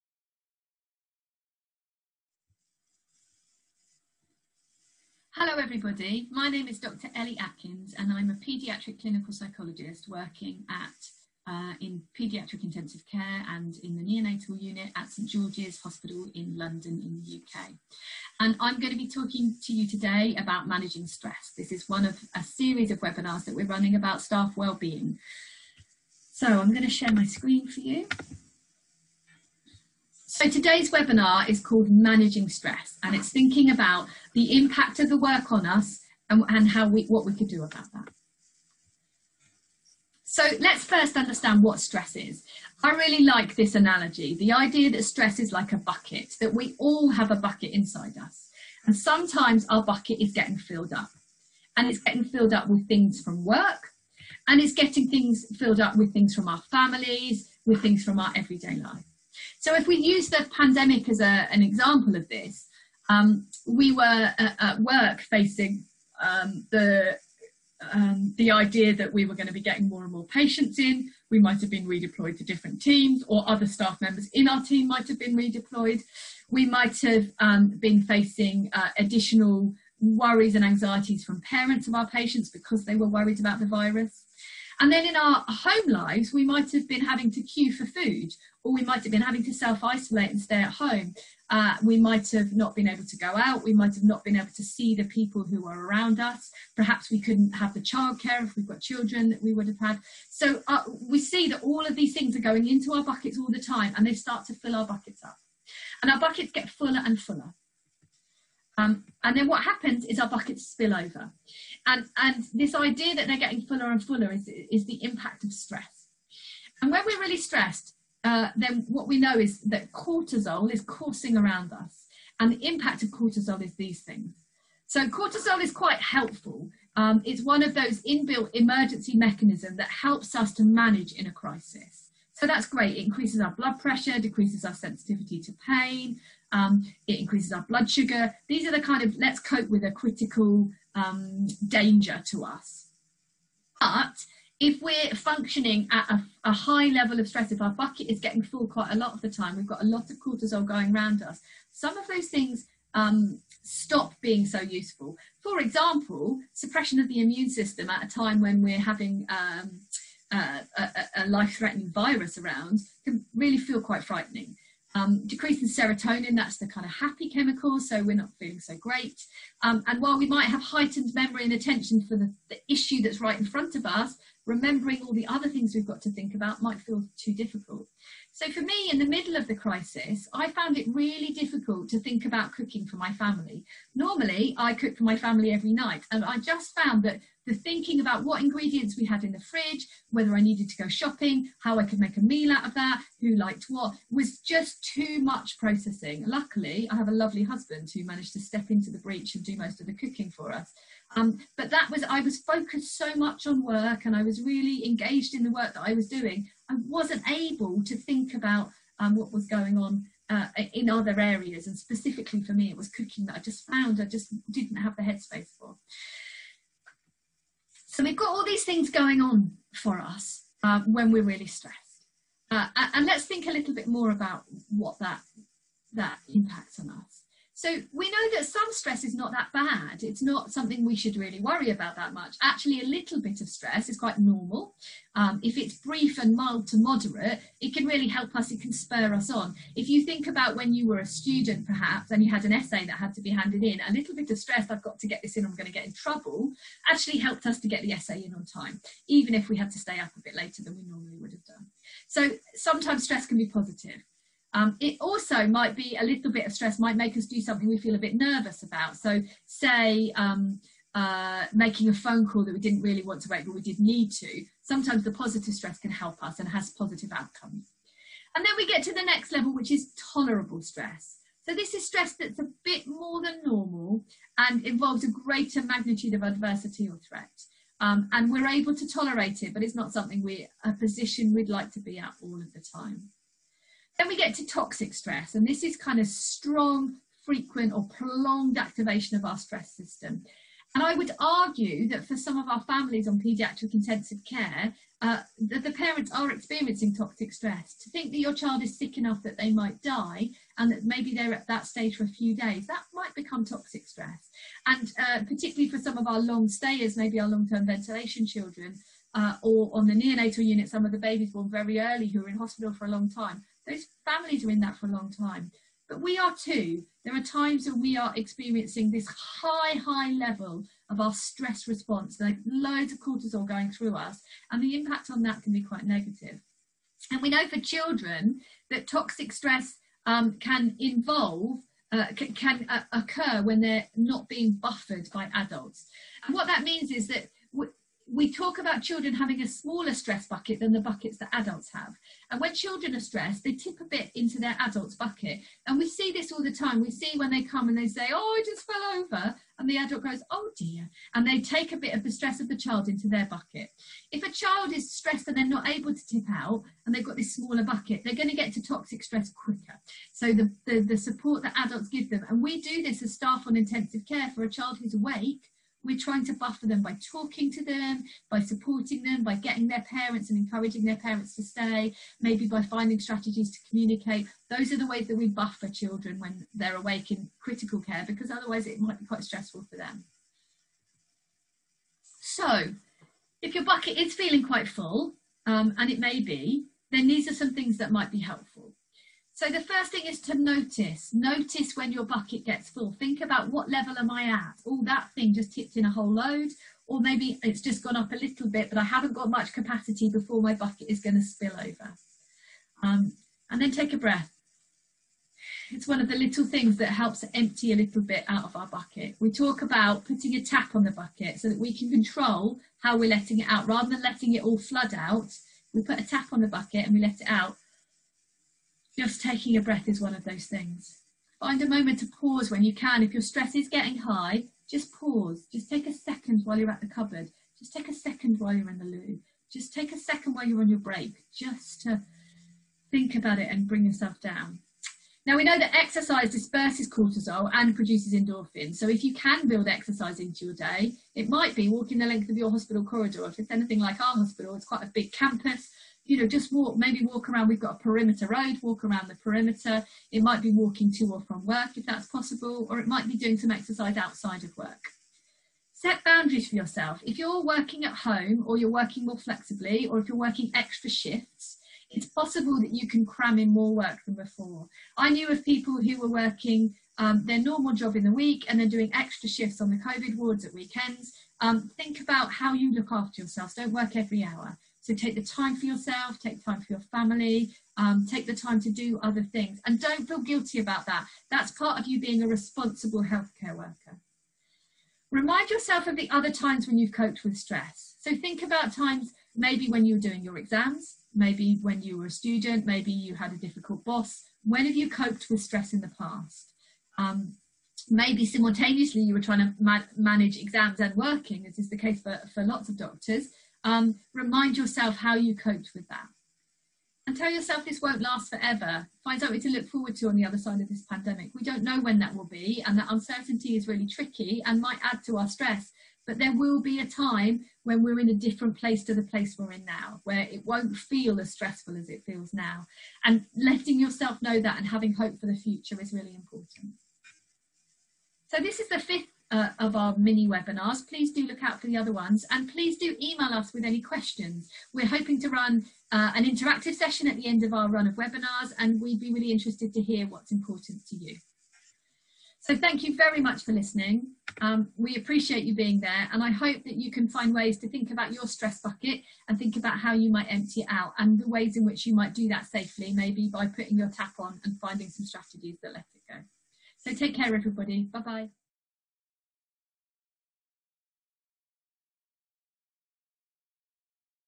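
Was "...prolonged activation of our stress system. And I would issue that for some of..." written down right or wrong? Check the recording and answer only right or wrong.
wrong.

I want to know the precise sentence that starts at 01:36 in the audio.
Perhaps we couldn't have the childcare if we've got children that we would have had.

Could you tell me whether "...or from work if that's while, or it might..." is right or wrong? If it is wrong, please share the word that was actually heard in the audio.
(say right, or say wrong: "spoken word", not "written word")
wrong: "possible", not "while".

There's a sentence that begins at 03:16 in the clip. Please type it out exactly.
Luckily, I have a lovely husband who managed to step into the breach and do most of the cooking for us.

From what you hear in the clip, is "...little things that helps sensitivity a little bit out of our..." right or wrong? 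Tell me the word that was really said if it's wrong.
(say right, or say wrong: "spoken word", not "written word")
wrong: "empty", not "sensitivity".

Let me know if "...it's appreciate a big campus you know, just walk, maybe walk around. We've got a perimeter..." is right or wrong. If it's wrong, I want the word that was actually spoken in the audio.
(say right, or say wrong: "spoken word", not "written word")
wrong: "quite", not "appreciate".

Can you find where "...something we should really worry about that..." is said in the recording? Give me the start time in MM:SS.
03:50.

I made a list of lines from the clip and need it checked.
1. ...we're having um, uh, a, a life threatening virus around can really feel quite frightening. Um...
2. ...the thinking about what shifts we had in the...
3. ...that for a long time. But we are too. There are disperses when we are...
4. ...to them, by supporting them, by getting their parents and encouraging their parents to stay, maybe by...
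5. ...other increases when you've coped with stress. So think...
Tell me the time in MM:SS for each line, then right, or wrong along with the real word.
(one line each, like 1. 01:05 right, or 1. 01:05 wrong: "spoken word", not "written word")
1. 02:38 right
2. 03:07 wrong: "ingredients", not "shifts"
3. 05:14 wrong: "times", not "disperses"
4. 06:07 right
5. 08:06 wrong: "times", not "increases".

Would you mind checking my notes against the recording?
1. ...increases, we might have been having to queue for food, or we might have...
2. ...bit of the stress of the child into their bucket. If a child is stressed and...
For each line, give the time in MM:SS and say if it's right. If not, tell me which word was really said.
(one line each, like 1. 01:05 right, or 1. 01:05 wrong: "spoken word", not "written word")
1. 01:25 wrong: "lives", not "increases"
2. 05:51 right.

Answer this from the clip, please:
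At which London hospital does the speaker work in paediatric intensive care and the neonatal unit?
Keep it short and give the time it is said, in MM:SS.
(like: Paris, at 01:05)
St George's Hospital, at 00:15.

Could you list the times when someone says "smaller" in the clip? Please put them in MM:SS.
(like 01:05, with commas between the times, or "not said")
05:39, 05:57.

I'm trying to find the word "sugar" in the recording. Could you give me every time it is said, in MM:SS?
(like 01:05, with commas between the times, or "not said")
02:17.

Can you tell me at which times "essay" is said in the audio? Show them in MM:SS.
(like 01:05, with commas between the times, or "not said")
04:02, 04:07.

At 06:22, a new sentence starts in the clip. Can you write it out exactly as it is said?
So, if your bucket is feeling quite full, um, and it may be, then these are some things that might be helpful.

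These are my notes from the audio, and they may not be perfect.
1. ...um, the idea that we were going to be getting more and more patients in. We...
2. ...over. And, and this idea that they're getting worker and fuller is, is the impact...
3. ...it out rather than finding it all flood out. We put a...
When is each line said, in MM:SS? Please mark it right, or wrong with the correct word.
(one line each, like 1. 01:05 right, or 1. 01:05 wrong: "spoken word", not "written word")
1. 01:07 right
2. 01:50 wrong: "fuller", not "worker"
3. 06:53 wrong: "letting", not "finding".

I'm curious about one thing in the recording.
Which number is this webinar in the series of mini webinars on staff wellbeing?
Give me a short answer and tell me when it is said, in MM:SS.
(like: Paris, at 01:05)
5, at 08:48.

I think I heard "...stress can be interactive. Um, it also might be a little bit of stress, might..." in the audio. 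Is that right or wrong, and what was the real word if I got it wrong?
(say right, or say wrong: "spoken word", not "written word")
wrong: "positive", not "interactive".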